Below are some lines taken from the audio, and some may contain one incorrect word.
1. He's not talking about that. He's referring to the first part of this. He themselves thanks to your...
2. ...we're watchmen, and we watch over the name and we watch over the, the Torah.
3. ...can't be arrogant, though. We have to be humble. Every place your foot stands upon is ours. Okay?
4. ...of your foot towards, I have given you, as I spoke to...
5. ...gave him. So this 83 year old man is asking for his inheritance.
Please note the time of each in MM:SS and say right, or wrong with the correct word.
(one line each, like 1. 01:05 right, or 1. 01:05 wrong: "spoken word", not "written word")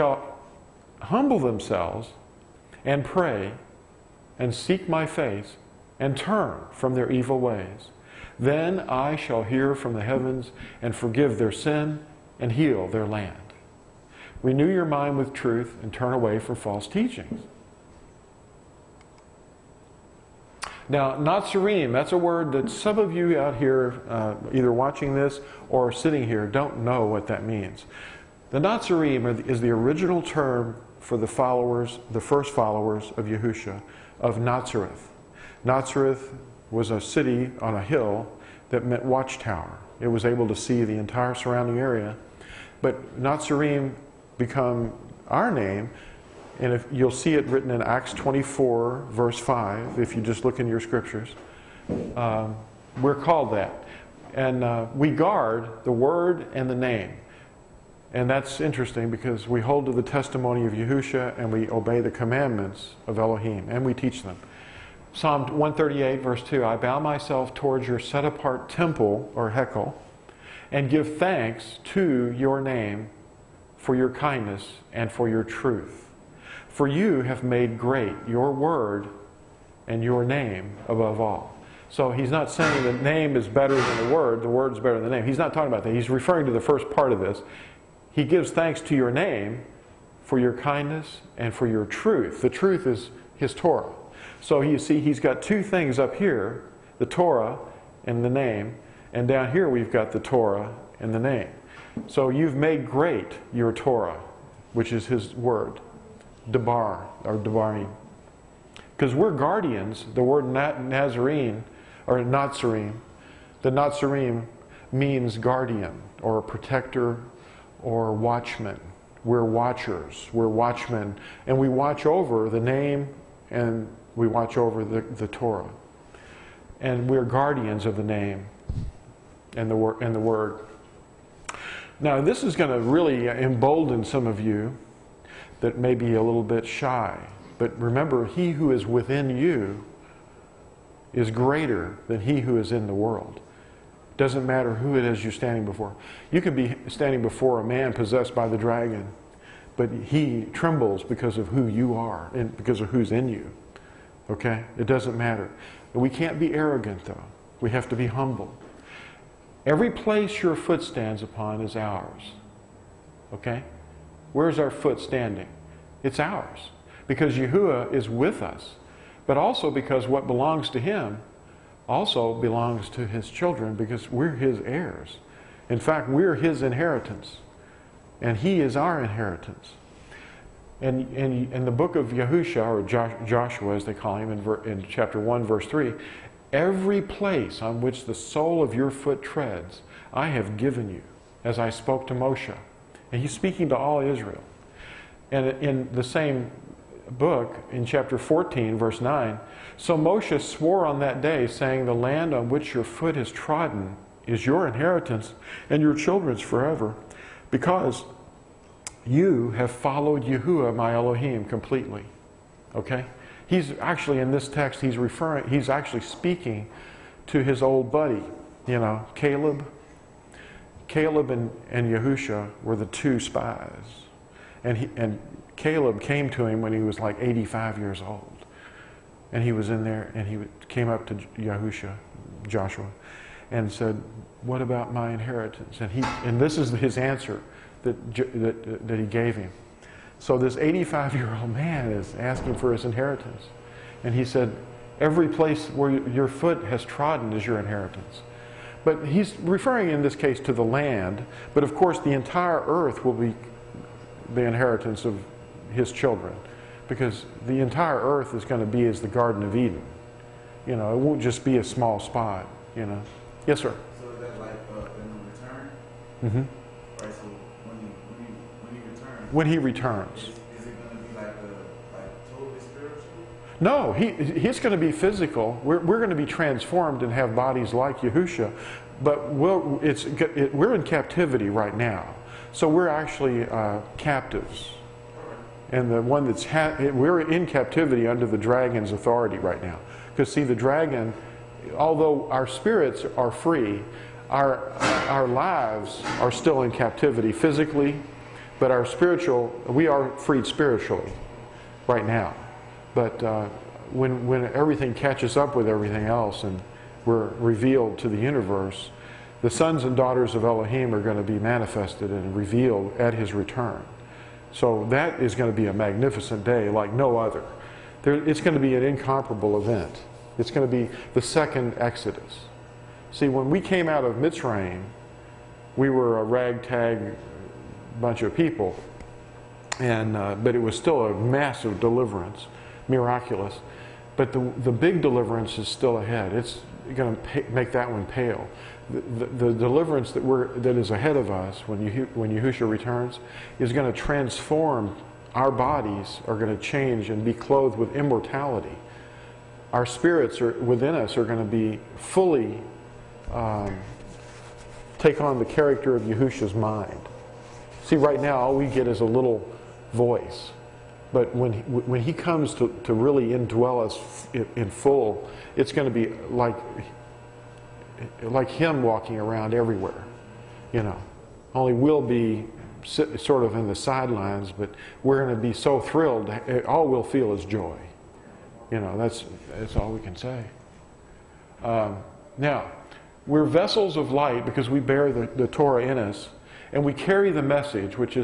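1. 01:25 wrong: "gives", not "themselves"
2. 02:00 right
3. 02:36 right
4. 03:08 wrong: "treads", not "towards"
5. 03:59 wrong: "85", not "83".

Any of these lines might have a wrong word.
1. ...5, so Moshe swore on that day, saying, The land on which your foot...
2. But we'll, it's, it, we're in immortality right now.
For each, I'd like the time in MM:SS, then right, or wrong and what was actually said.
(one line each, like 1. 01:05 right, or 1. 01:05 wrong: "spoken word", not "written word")
1. 03:19 wrong: "9", not "5"
2. 04:39 wrong: "captivity", not "immortality".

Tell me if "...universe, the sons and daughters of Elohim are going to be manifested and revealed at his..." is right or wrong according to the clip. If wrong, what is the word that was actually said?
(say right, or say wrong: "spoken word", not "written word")
right.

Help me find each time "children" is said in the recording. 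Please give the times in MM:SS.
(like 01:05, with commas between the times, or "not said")
02:53, 03:25, 04:15.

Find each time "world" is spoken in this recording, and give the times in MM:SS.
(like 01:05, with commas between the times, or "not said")
02:22.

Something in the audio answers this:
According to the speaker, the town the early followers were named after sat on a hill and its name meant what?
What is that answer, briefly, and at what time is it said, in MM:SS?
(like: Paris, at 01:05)
Watchtower, at 00:39.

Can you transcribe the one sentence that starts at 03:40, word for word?
Caleb and, and Yahusha were the two spies.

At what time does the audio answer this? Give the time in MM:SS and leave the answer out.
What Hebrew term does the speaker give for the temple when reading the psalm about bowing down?
01:09.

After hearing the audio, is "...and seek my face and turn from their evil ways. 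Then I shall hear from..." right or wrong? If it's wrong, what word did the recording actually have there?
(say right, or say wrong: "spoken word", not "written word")
right.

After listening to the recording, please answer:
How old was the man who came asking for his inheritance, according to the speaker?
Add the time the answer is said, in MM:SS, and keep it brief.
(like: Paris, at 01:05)
85, at 03:47.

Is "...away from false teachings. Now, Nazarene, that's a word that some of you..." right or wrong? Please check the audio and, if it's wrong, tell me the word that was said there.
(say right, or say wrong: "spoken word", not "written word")
right.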